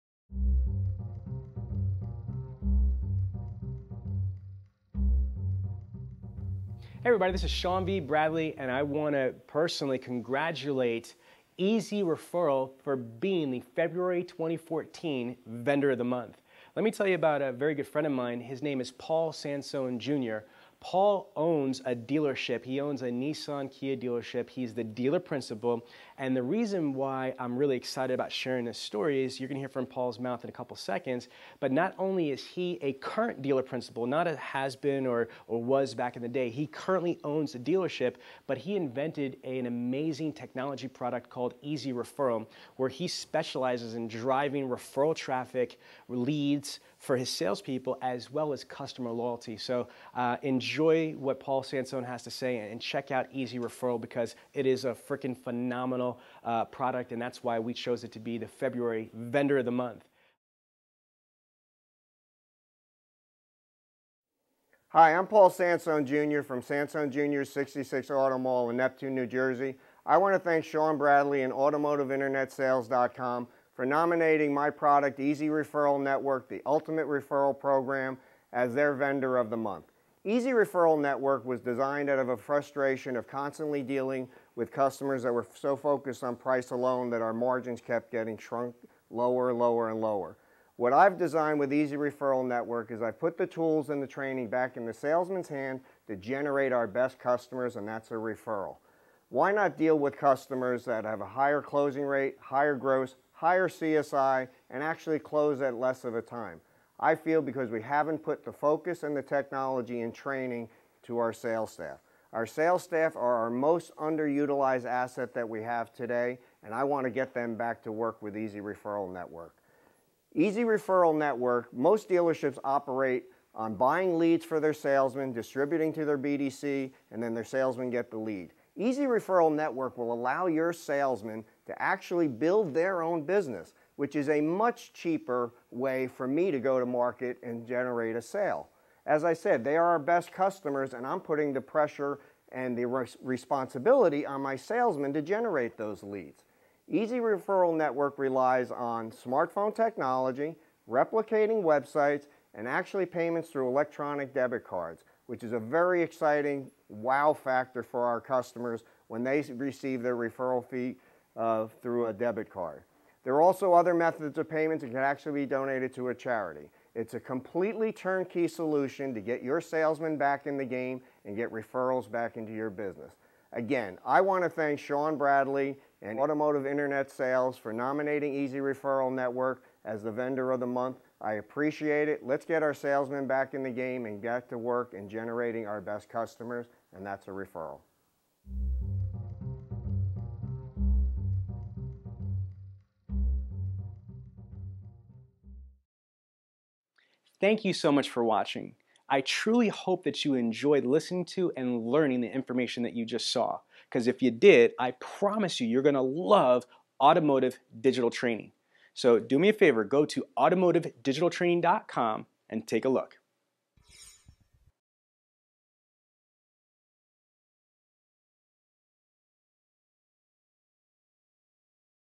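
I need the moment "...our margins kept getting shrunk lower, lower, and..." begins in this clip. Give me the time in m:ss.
1:27.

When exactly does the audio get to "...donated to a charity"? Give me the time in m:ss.
2:45.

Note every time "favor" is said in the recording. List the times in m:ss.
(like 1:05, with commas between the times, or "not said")
3:29.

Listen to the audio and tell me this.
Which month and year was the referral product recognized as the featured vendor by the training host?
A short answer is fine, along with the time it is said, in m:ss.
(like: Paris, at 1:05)
February 2014, at 0:13.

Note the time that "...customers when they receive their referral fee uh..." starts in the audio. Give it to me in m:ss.
2:38.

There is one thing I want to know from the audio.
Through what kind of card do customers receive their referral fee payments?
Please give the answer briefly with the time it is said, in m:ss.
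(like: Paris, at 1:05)
Electronic debit cards, at 2:33.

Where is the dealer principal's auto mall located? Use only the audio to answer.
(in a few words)
Neptune, New Jersey.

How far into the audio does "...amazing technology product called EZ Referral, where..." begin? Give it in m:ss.
0:39.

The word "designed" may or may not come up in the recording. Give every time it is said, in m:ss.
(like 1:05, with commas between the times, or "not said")
1:21, 1:31.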